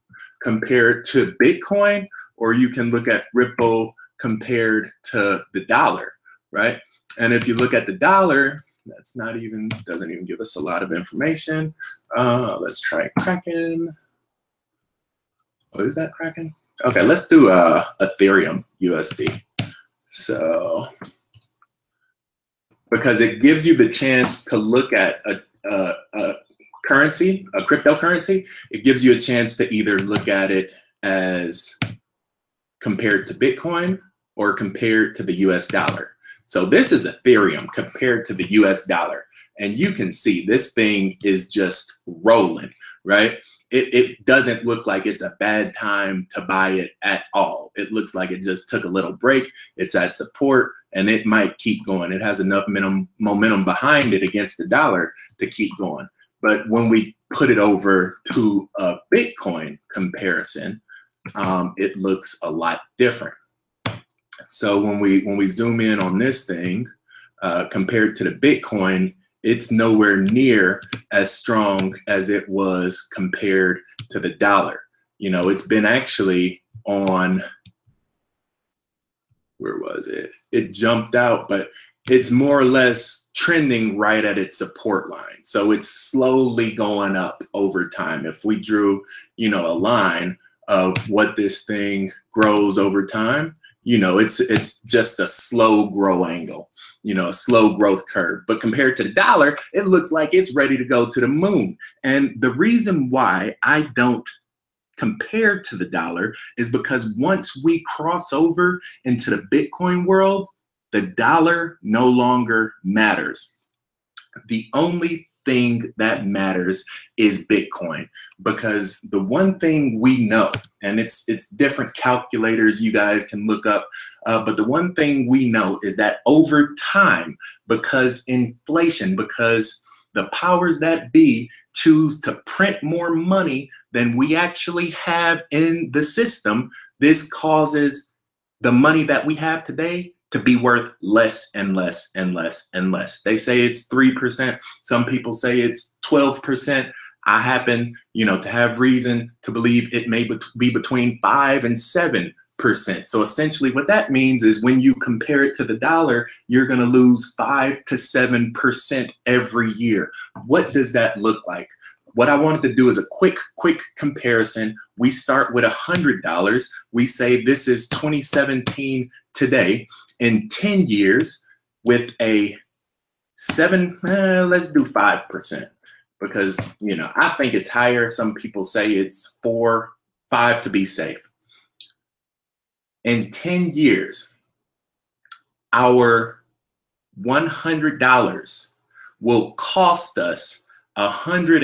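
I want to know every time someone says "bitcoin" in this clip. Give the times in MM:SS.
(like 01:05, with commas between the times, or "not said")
00:01, 00:33, 00:59, 01:08, 01:49, 01:57.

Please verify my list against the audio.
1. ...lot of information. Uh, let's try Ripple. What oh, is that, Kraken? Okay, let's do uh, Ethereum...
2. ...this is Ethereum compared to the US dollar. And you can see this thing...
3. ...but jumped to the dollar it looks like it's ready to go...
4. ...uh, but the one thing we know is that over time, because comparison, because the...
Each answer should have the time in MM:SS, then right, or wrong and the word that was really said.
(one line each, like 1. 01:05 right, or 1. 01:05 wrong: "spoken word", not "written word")
1. 00:10 wrong: "Kraken", not "Ripple"
2. 00:36 right
3. 01:38 wrong: "compared", not "jumped"
4. 02:04 wrong: "inflation", not "comparison".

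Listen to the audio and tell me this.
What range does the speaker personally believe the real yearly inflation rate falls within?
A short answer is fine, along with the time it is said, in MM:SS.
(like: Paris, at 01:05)
5 to 7%, at 02:30.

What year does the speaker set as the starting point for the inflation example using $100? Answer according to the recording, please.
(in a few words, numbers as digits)
2017.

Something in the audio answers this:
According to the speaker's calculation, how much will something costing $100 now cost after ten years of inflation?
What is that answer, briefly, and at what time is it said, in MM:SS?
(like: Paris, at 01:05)
$162, at 03:10.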